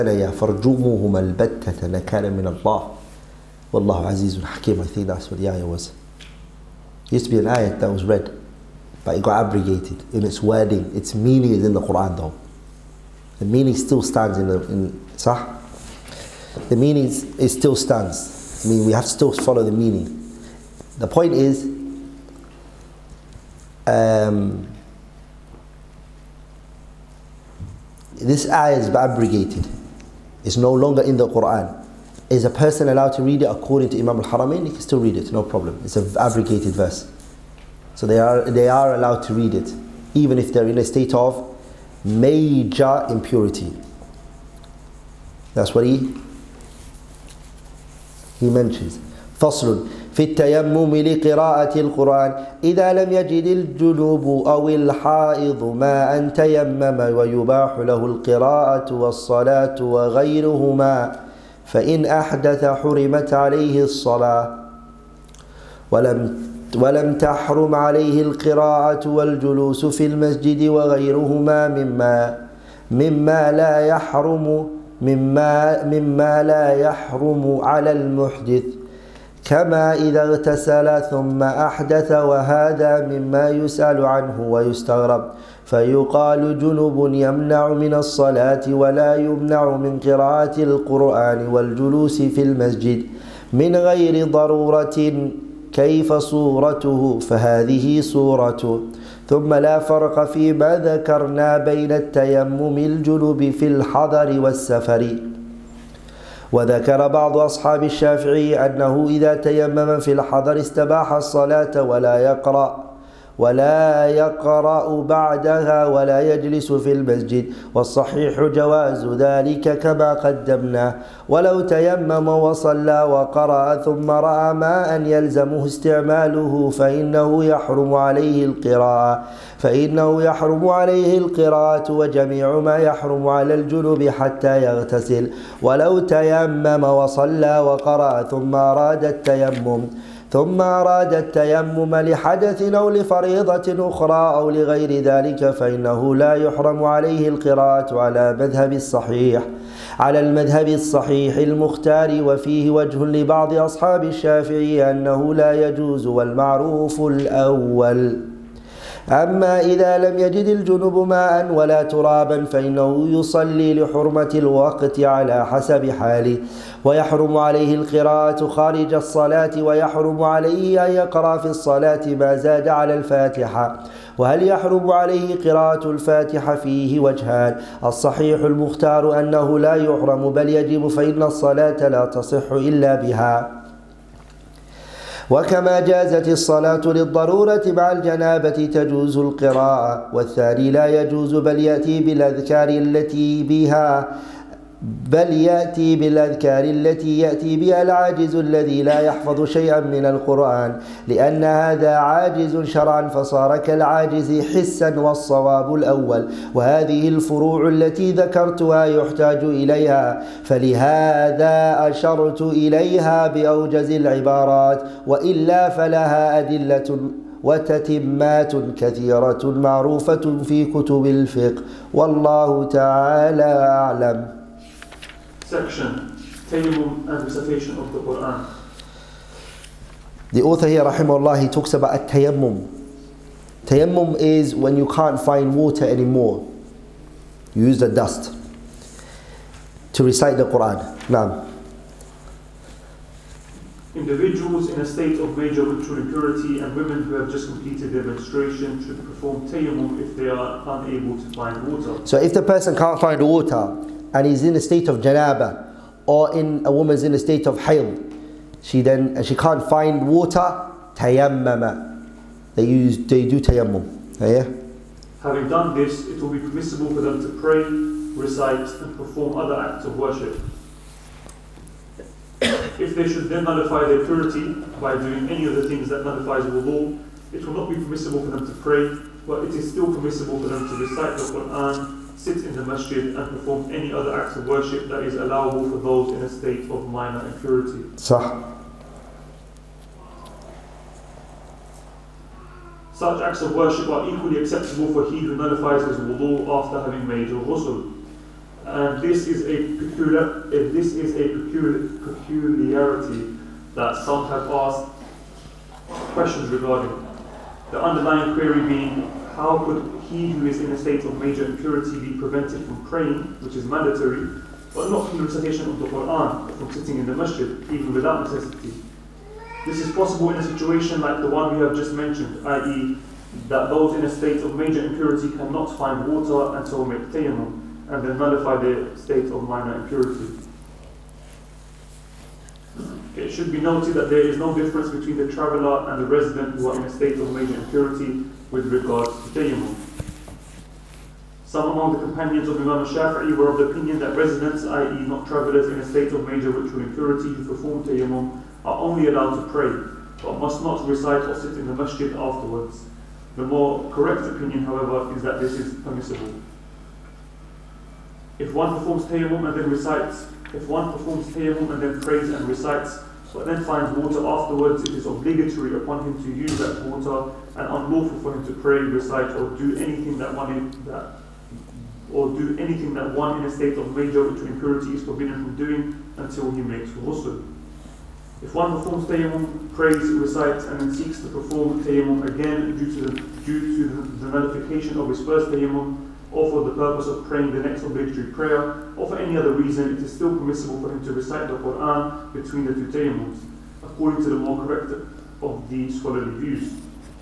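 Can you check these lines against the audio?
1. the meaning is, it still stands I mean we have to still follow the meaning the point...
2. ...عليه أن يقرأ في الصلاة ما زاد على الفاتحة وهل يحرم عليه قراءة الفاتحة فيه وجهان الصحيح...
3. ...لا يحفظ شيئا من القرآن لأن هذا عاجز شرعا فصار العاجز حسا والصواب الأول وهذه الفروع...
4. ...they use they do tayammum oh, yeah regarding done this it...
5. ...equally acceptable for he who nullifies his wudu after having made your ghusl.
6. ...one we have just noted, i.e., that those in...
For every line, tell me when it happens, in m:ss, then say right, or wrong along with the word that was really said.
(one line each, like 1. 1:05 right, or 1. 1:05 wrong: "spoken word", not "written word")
1. 0:16 right
2. 2:50 right
3. 3:18 wrong: "كالعاجز", not "العاجز"
4. 4:22 wrong: "having", not "regarding"
5. 4:54 right
6. 5:21 wrong: "mentioned", not "noted".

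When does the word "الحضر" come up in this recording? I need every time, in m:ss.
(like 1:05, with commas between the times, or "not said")
1:43, 1:50.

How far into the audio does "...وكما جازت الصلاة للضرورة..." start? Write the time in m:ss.
3:05.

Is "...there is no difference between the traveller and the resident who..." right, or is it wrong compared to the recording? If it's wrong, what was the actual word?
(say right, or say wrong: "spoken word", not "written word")
right.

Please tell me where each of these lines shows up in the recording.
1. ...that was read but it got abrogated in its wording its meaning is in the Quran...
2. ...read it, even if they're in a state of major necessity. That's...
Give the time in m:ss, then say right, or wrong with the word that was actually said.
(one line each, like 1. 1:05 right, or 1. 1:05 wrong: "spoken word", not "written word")
1. 0:07 right
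2. 0:39 wrong: "impurity", not "necessity".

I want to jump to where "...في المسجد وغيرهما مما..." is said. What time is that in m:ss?
1:09.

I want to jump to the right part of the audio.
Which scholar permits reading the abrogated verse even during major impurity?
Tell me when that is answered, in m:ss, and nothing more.
0:33.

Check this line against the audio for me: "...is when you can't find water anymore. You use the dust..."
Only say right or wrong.
right.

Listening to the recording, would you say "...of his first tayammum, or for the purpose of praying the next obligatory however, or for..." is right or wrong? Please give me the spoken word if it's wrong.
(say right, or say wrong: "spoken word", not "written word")
wrong: "prayer", not "however".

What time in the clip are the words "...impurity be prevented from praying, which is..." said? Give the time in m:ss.
5:11.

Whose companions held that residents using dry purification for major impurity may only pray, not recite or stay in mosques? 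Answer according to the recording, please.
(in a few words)
Imam Shafi'i.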